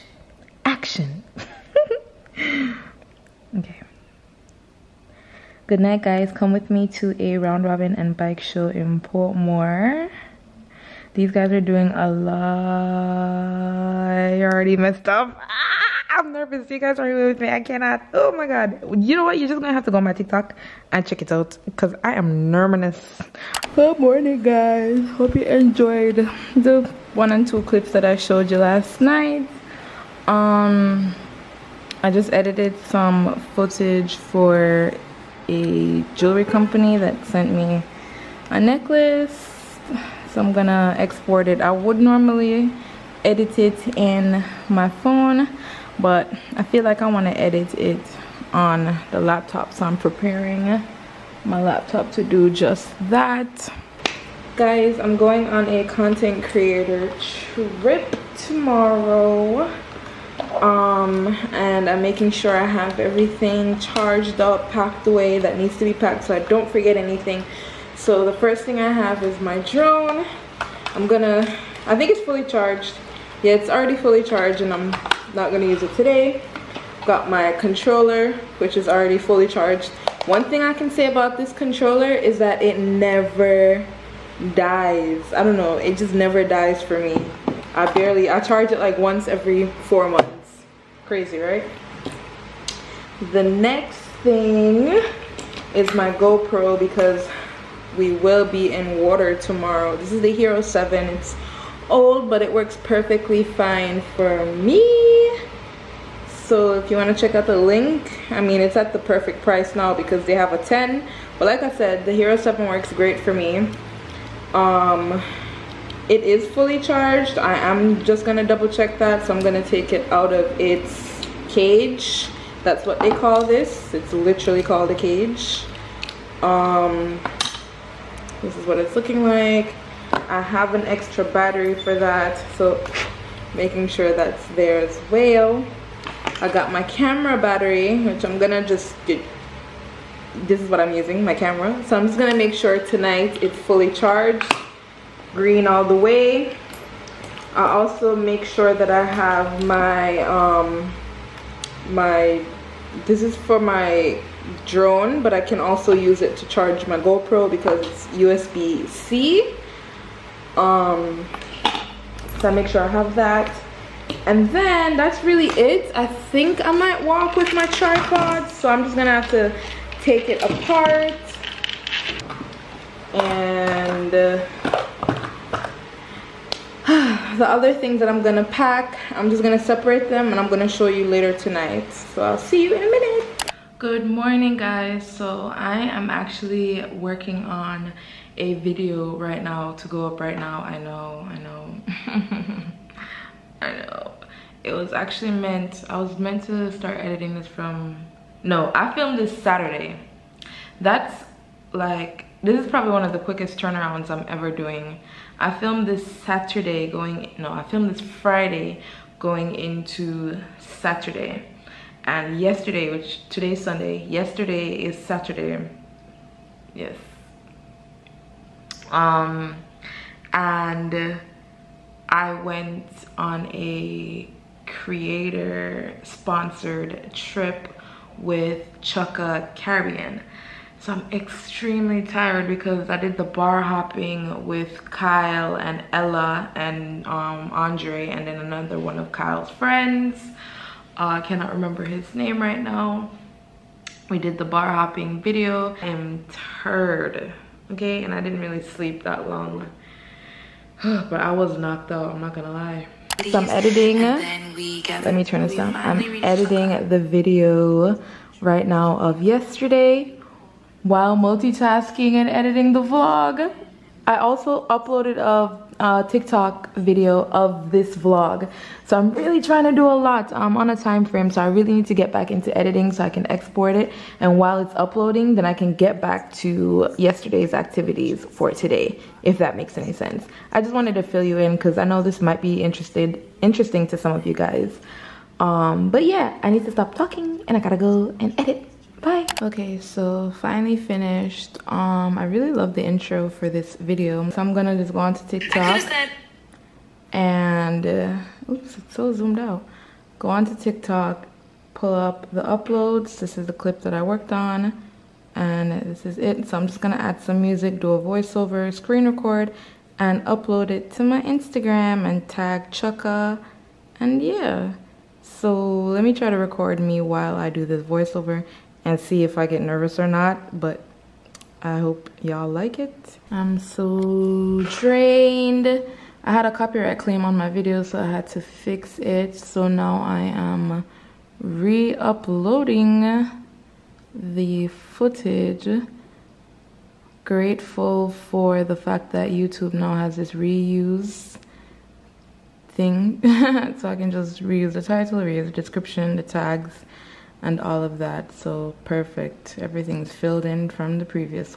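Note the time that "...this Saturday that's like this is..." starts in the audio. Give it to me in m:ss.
3:19.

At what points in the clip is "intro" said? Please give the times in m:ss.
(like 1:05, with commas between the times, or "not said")
4:52.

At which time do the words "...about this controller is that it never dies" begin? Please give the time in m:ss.
1:21.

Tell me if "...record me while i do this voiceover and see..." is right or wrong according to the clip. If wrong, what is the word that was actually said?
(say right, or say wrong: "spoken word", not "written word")
right.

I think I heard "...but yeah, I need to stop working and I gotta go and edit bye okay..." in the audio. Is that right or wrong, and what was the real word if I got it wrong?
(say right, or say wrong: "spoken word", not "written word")
wrong: "talking", not "working".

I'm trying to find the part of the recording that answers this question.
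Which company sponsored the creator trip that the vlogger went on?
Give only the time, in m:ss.
3:48.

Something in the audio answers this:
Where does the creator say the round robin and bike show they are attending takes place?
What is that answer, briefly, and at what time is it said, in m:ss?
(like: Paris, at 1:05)
Portmore, at 0:09.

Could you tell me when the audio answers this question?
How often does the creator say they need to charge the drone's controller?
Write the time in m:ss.
1:28.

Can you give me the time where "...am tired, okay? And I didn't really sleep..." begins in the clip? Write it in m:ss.
4:05.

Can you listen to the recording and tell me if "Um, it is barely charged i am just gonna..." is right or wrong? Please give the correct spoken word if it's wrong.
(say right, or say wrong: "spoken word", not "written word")
wrong: "fully", not "barely".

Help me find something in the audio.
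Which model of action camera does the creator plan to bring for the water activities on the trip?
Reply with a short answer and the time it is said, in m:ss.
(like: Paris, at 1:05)
Hero 7, at 1:39.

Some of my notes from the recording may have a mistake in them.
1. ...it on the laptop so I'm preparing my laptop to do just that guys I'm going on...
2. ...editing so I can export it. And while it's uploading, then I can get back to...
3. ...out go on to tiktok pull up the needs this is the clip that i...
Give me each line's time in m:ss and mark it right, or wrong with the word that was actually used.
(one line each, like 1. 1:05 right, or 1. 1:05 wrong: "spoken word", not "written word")
1. 0:47 right
2. 4:32 right
3. 4:59 wrong: "uploads", not "needs".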